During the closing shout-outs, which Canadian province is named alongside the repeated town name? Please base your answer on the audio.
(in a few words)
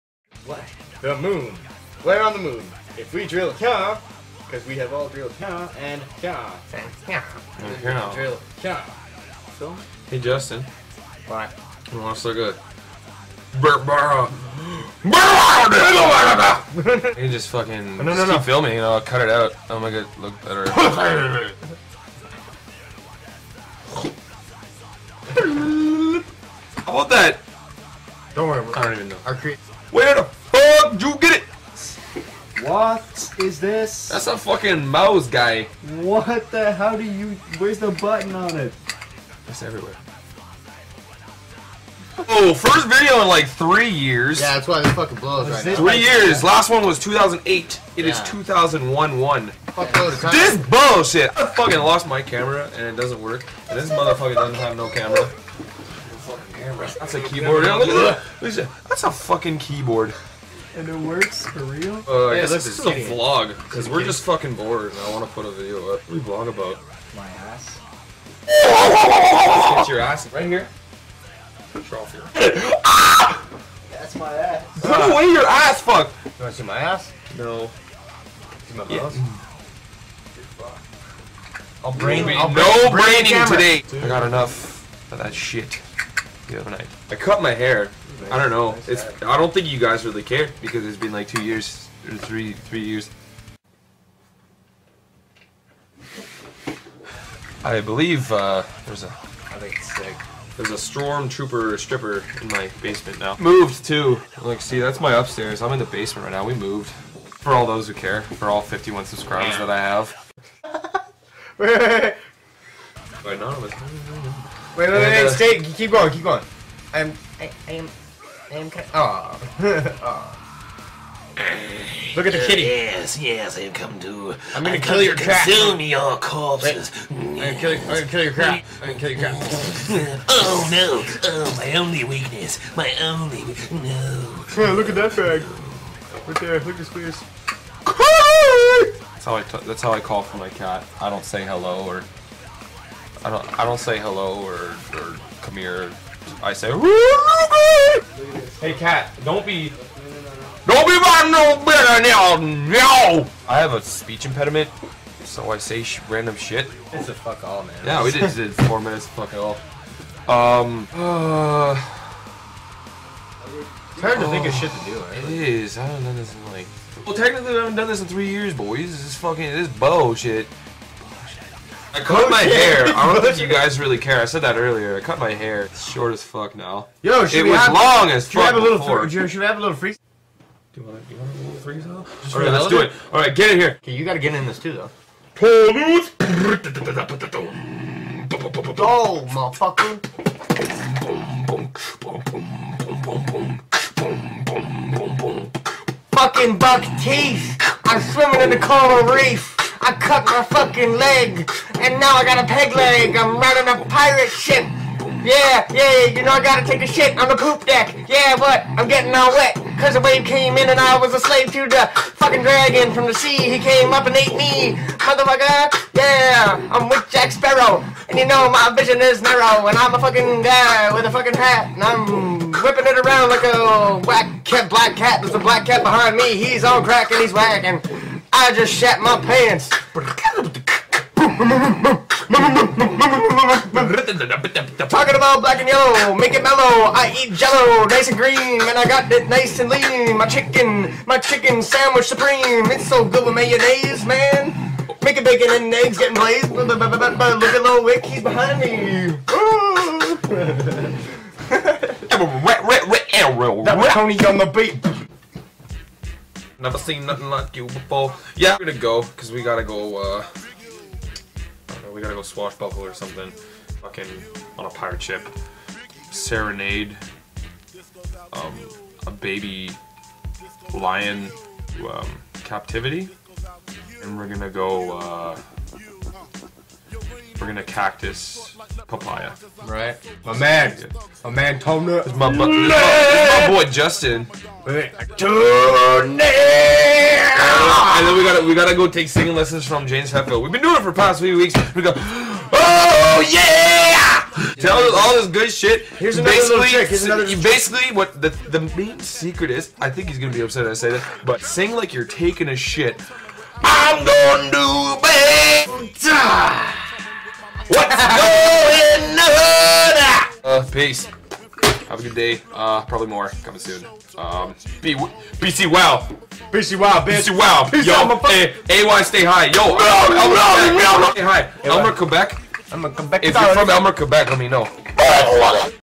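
Quebec.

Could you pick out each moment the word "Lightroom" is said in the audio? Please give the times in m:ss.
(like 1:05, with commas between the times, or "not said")
not said.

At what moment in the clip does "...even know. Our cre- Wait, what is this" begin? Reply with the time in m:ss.
0:28.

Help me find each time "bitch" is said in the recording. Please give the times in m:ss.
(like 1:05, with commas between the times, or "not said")
5:17.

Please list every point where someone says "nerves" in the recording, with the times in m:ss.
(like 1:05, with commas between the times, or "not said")
not said.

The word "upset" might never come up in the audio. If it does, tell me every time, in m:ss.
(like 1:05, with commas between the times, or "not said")
5:00.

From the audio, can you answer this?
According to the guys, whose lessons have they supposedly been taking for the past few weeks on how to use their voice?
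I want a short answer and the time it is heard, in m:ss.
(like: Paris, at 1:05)
James Hetfield, at 4:49.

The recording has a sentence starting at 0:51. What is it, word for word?
I fucking lost my camera and it doesn't work.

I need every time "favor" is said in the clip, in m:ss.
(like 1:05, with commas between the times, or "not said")
not said.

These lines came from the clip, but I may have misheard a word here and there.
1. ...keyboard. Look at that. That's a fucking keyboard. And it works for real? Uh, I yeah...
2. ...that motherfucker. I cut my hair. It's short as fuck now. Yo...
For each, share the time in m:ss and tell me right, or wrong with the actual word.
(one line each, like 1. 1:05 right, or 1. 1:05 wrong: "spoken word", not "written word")
1. 0:57 right
2. 2:54 wrong: "earlier", not "motherfucker".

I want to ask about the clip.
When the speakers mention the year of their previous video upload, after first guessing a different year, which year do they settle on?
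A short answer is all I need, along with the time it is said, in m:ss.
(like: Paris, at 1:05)
2001, at 0:48.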